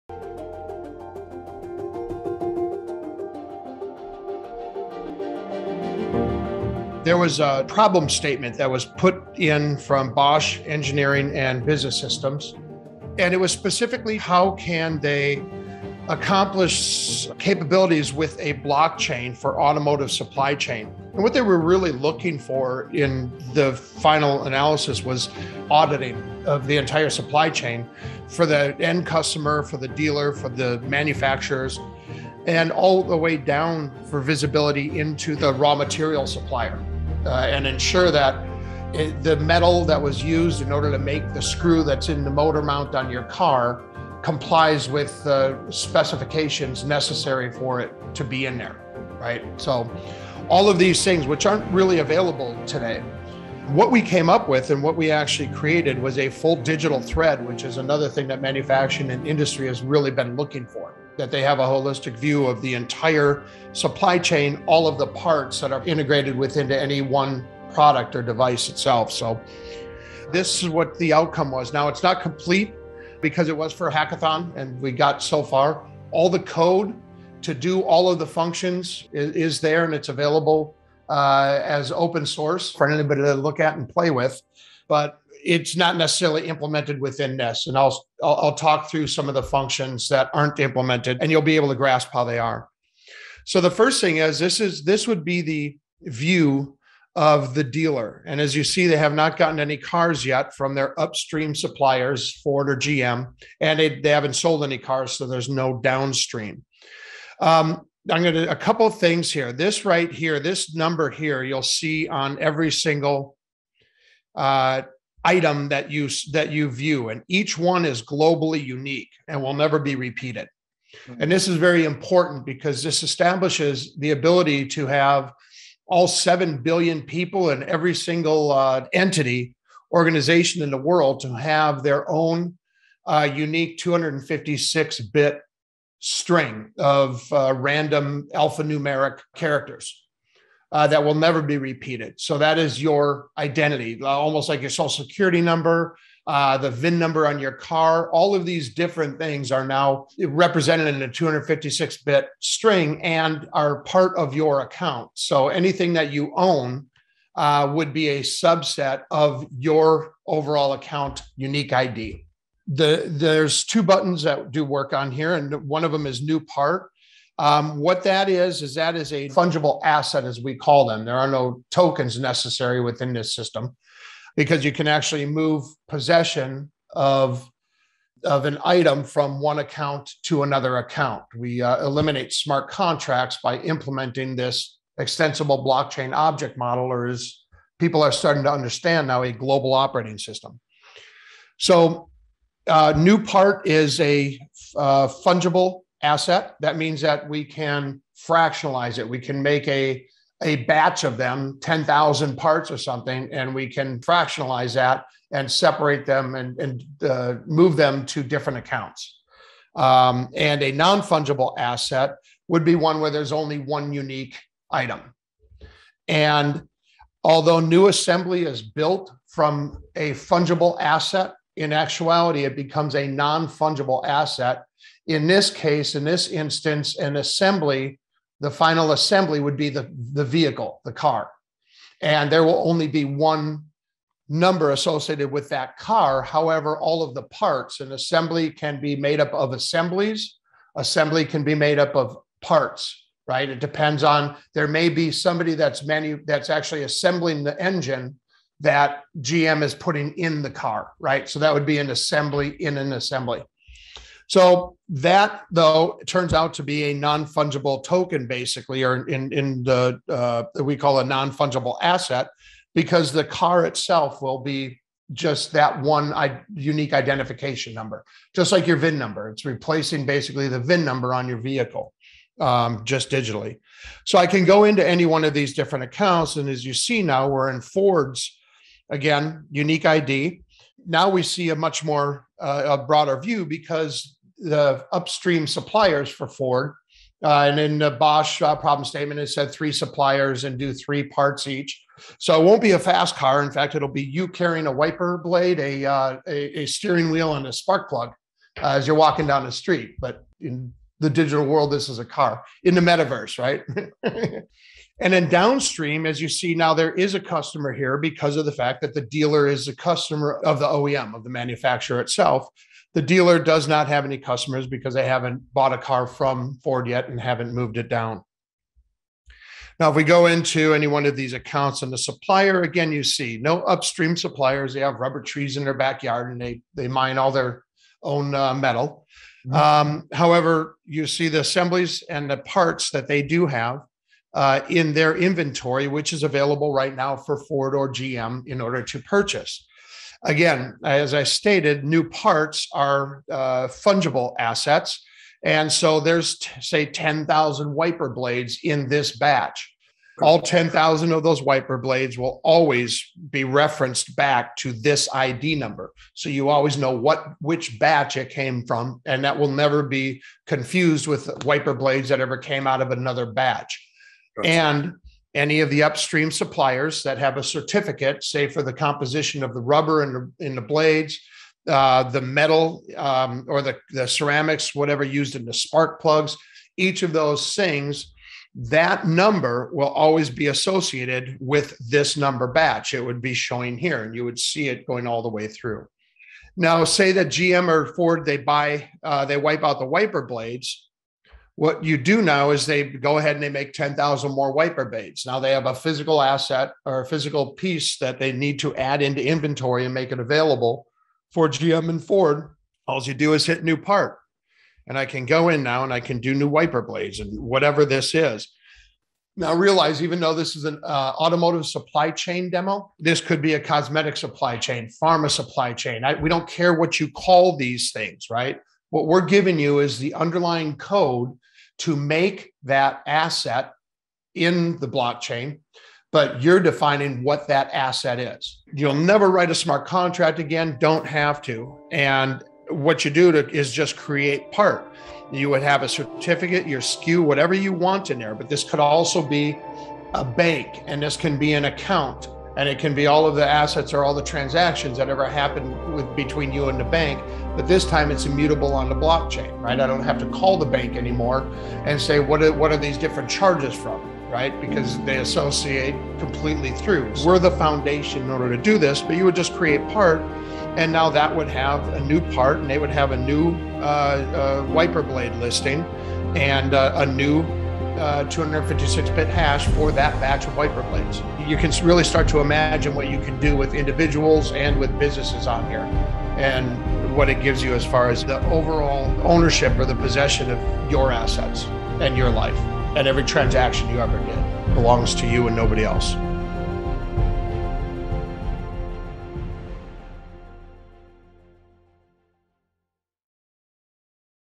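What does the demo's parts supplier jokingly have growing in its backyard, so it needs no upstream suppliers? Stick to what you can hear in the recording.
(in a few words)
rubber trees.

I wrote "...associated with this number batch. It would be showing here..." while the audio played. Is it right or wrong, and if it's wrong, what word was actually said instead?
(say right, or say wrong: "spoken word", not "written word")
right.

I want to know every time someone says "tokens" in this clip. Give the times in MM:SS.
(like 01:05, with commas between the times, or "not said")
02:51, 04:17.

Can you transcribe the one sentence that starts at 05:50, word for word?
All 10,000 of those wiper blades will always be referenced back to this ID number.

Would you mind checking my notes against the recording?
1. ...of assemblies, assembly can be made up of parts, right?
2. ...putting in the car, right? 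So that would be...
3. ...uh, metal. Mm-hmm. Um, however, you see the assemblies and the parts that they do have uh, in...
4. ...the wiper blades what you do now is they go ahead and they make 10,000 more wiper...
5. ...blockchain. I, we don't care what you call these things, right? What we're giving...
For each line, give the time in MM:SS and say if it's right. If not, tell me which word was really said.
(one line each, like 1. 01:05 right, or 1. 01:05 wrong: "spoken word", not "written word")
1. 03:59 right
2. 04:09 right
3. 05:28 right
4. 06:29 right
5. 06:55 wrong: "chain", not "blockchain".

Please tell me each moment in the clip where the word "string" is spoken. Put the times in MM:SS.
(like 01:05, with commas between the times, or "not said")
02:15, 02:32.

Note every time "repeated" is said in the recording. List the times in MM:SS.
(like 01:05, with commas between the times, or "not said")
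01:59, 02:21.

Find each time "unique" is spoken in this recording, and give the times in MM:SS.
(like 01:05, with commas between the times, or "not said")
01:58, 02:13, 02:41, 03:33, 04:26, 04:39.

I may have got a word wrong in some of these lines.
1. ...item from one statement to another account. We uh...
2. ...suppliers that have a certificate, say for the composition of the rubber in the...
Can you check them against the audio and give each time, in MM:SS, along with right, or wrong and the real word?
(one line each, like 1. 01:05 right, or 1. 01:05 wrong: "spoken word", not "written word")
1. 02:58 wrong: "account", not "statement"
2. 06:06 right.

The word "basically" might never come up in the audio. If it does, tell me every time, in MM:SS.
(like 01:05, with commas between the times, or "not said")
04:18, 04:30.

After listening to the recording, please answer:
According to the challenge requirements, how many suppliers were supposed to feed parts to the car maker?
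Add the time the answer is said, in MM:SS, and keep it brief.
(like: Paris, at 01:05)
3, at 04:49.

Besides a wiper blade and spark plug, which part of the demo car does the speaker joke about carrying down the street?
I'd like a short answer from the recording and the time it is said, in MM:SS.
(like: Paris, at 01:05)
steering wheel, at 04:56.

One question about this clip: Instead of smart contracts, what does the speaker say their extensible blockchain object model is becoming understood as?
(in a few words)
global operating system.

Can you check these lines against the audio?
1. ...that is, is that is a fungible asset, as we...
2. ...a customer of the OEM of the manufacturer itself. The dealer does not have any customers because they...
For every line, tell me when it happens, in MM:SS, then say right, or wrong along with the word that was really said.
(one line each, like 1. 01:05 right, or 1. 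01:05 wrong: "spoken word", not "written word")
1. 02:48 right
2. 05:09 right.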